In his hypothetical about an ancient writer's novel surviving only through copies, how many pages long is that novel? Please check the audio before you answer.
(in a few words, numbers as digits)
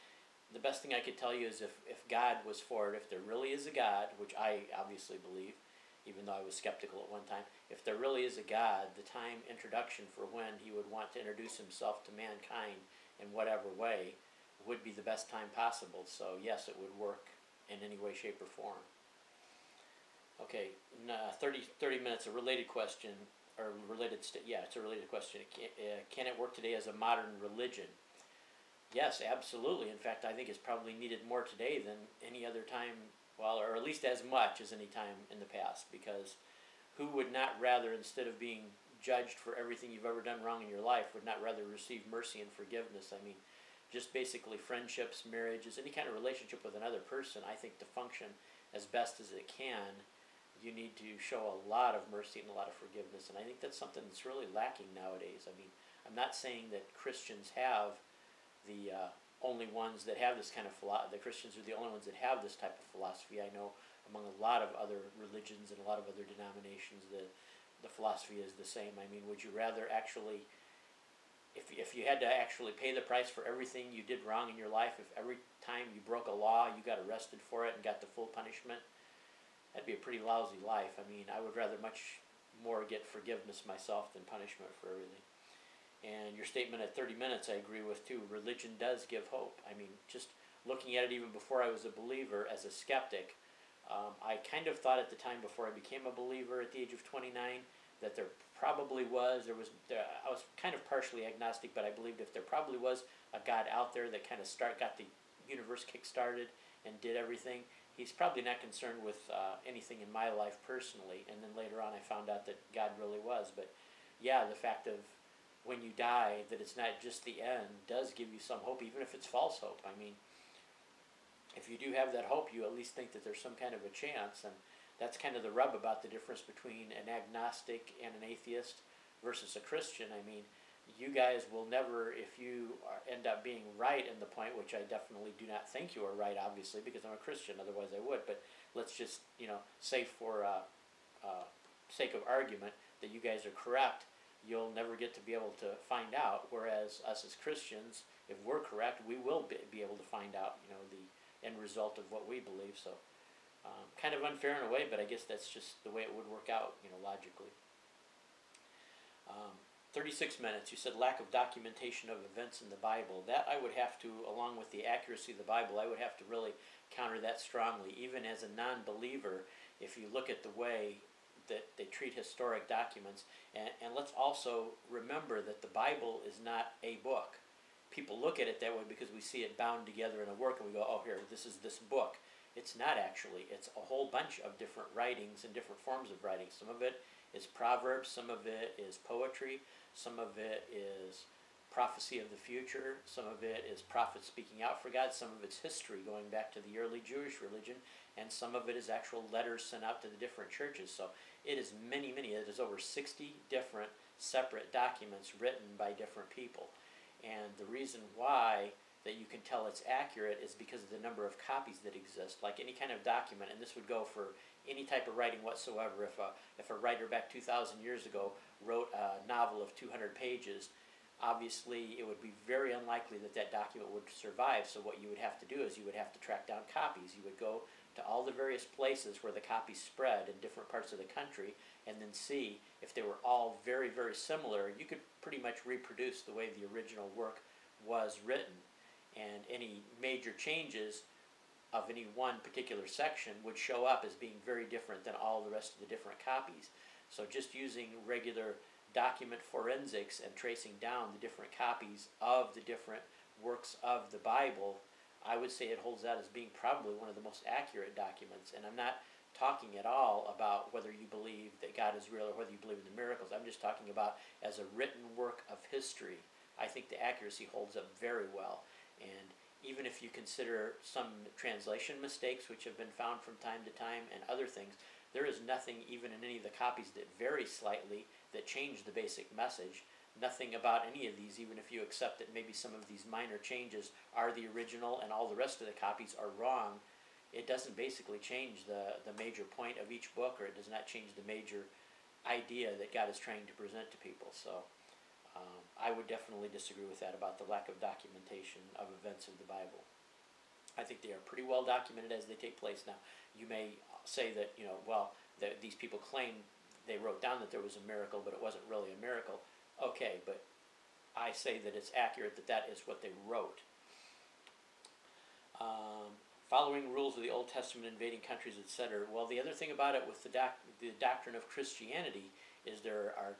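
200.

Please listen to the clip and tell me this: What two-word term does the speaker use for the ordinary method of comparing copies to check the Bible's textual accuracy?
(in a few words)
document forensics.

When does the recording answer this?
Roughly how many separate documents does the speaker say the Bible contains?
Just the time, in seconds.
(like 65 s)
202 s.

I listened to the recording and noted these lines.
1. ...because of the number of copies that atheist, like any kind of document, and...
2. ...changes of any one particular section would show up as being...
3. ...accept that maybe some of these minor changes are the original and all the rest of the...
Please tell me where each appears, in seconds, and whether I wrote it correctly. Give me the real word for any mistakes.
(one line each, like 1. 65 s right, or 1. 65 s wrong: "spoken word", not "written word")
1. 210 s wrong: "exist", not "atheist"
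2. 240 s right
3. 281 s right.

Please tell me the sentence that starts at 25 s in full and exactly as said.
Can, uh, can it work today as a modern religion?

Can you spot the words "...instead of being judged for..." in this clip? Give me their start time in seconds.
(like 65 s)
37 s.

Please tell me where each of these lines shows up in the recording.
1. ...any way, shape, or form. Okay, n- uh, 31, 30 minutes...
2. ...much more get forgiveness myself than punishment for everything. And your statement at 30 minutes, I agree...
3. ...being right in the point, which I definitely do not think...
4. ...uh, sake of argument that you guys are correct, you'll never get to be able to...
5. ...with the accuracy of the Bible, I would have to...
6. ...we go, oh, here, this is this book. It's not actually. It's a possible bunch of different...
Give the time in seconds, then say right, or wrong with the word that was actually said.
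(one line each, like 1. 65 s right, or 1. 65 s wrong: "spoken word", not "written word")
1. 17 s wrong: "30", not "31"
2. 81 s right
3. 133 s right
4. 141 s right
5. 164 s right
6. 180 s wrong: "whole", not "possible".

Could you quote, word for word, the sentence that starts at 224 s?
So what you would have to do is you would have to track down copies.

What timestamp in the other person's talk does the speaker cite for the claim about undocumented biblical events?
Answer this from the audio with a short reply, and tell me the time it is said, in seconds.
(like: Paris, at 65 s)
36 minutes, at 159 s.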